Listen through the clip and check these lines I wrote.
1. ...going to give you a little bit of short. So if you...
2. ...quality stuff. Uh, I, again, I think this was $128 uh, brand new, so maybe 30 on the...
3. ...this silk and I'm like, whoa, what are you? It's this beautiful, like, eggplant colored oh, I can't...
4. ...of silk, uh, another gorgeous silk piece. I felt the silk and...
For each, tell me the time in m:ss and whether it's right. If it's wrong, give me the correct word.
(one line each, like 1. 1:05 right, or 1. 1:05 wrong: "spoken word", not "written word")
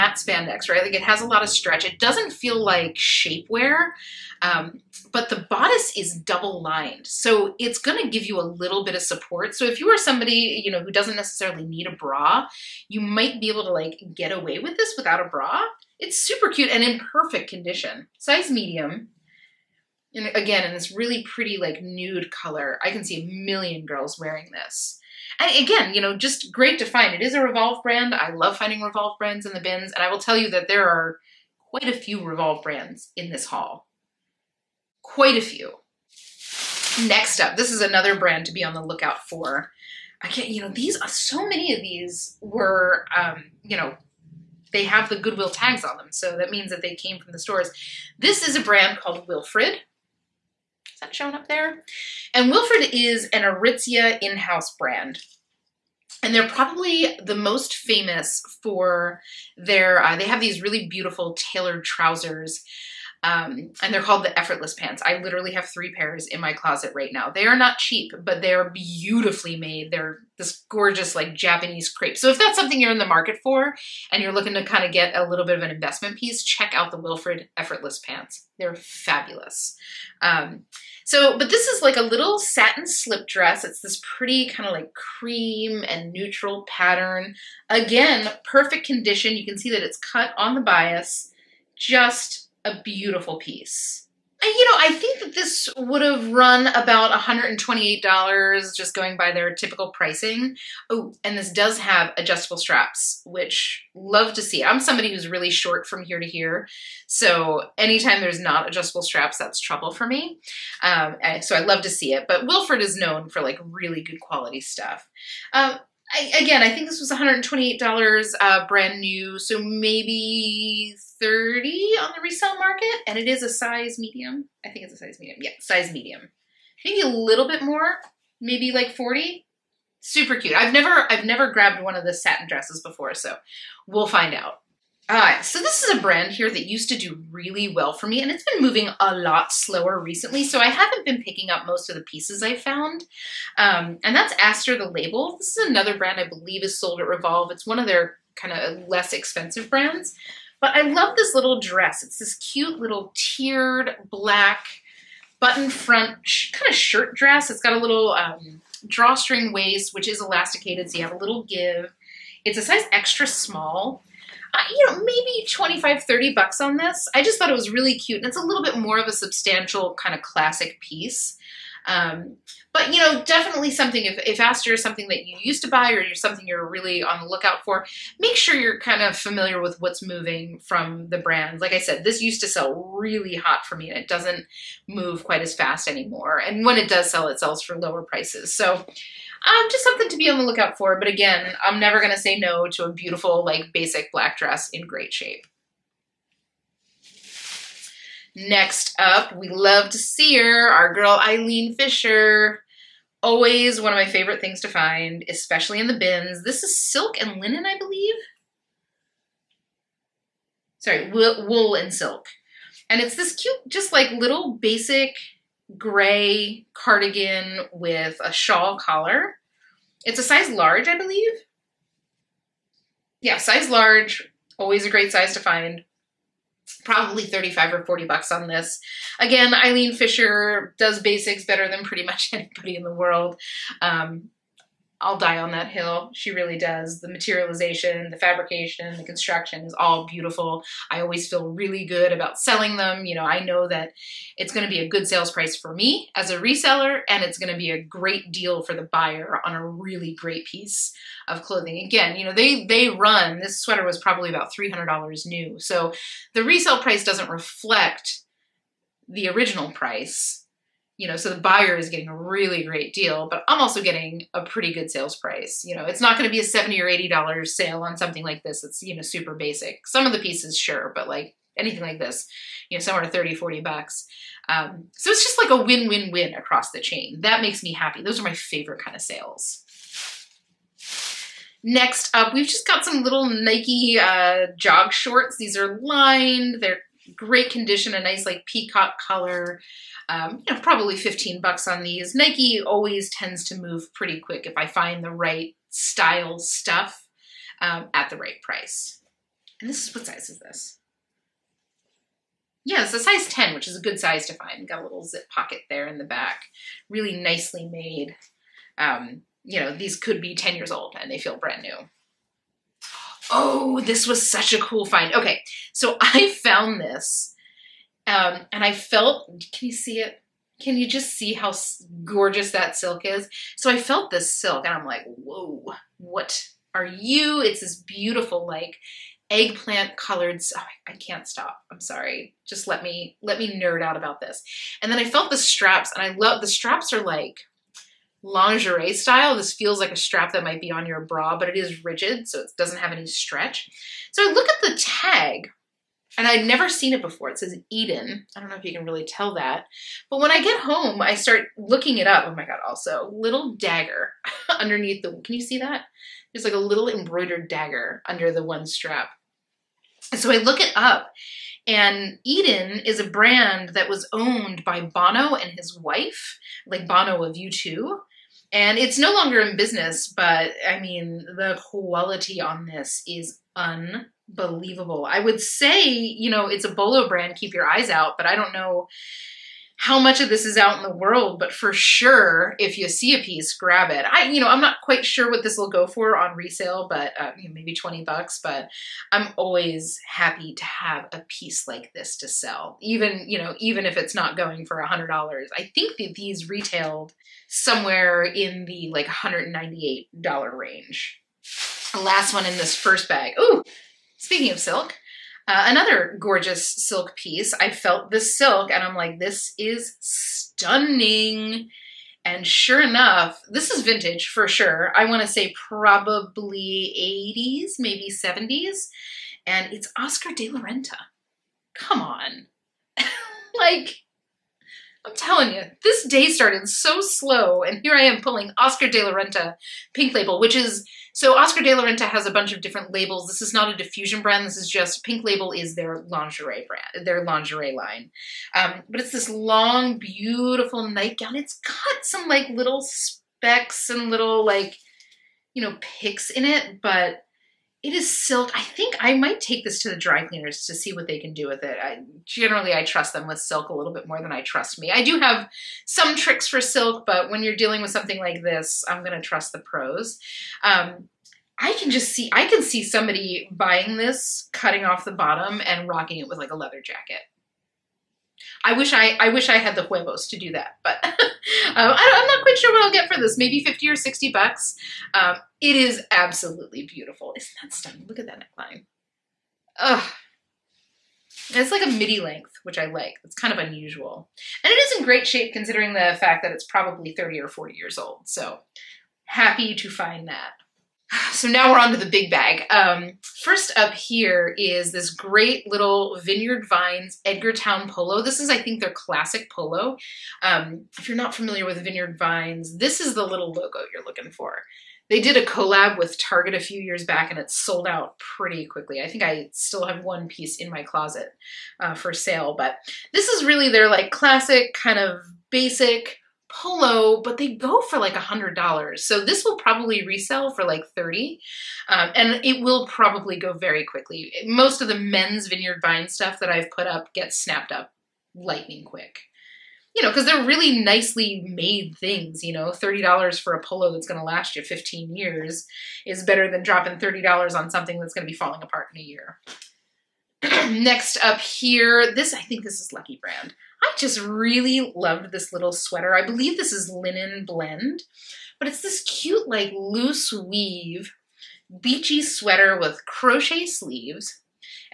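1. 0:07 wrong: "support", not "short"
2. 1:54 right
3. 5:24 right
4. 6:44 right.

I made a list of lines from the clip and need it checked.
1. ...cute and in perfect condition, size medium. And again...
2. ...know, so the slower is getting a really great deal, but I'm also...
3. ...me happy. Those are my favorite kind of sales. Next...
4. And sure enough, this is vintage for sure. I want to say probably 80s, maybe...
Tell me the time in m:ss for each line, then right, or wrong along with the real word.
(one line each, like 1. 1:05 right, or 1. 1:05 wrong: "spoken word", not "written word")
1. 0:16 right
2. 4:21 wrong: "buyer", not "slower"
3. 4:37 right
4. 6:52 right.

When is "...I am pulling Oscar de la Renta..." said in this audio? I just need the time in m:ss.
7:07.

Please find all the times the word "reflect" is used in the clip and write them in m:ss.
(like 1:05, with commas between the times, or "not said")
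4:17.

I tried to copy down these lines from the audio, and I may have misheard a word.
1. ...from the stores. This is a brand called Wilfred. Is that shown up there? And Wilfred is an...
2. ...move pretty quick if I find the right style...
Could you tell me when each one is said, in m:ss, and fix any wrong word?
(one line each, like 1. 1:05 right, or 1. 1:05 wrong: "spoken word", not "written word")
1. 0:47 right
2. 4:53 right.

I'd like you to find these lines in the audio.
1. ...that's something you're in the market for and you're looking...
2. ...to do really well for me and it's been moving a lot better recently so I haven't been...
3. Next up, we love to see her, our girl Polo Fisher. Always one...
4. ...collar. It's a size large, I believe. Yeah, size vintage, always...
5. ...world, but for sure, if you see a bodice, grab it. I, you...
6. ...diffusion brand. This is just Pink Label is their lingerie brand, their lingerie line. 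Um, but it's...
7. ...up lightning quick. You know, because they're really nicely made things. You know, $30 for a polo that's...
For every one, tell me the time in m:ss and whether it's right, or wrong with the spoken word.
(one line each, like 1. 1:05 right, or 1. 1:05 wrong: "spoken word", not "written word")
1. 1:12 right
2. 2:16 wrong: "slower", not "better"
3. 3:18 wrong: "Eileen", not "Polo"
4. 3:38 wrong: "large", not "vintage"
5. 6:20 wrong: "piece", not "bodice"
6. 7:13 right
7. 8:47 right.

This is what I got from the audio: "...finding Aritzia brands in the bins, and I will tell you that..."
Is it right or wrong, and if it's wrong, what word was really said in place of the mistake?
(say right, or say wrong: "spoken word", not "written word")
wrong: "Revolve", not "Aritzia".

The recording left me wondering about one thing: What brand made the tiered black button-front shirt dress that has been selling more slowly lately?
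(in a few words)
ASTR the label.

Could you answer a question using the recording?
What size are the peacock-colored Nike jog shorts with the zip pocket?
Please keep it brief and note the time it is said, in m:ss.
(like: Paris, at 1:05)
10, at 5:02.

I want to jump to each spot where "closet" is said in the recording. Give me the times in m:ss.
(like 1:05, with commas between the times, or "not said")
1:06, 8:30.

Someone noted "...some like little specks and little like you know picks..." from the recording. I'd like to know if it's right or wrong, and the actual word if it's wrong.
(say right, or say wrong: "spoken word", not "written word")
right.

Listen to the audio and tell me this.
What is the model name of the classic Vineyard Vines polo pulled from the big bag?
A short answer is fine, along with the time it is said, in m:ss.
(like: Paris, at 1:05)
Edgartown Polo, at 8:17.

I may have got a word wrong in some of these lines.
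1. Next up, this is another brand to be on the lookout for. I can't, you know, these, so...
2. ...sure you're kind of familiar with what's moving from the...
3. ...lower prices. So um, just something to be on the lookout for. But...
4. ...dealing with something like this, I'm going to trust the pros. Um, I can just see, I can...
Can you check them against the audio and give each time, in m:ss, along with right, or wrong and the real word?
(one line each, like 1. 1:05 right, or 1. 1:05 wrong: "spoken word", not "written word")
1. 0:37 right
2. 2:58 right
3. 3:07 right
4. 7:37 right.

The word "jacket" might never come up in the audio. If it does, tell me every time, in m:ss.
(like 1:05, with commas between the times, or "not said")
7:46.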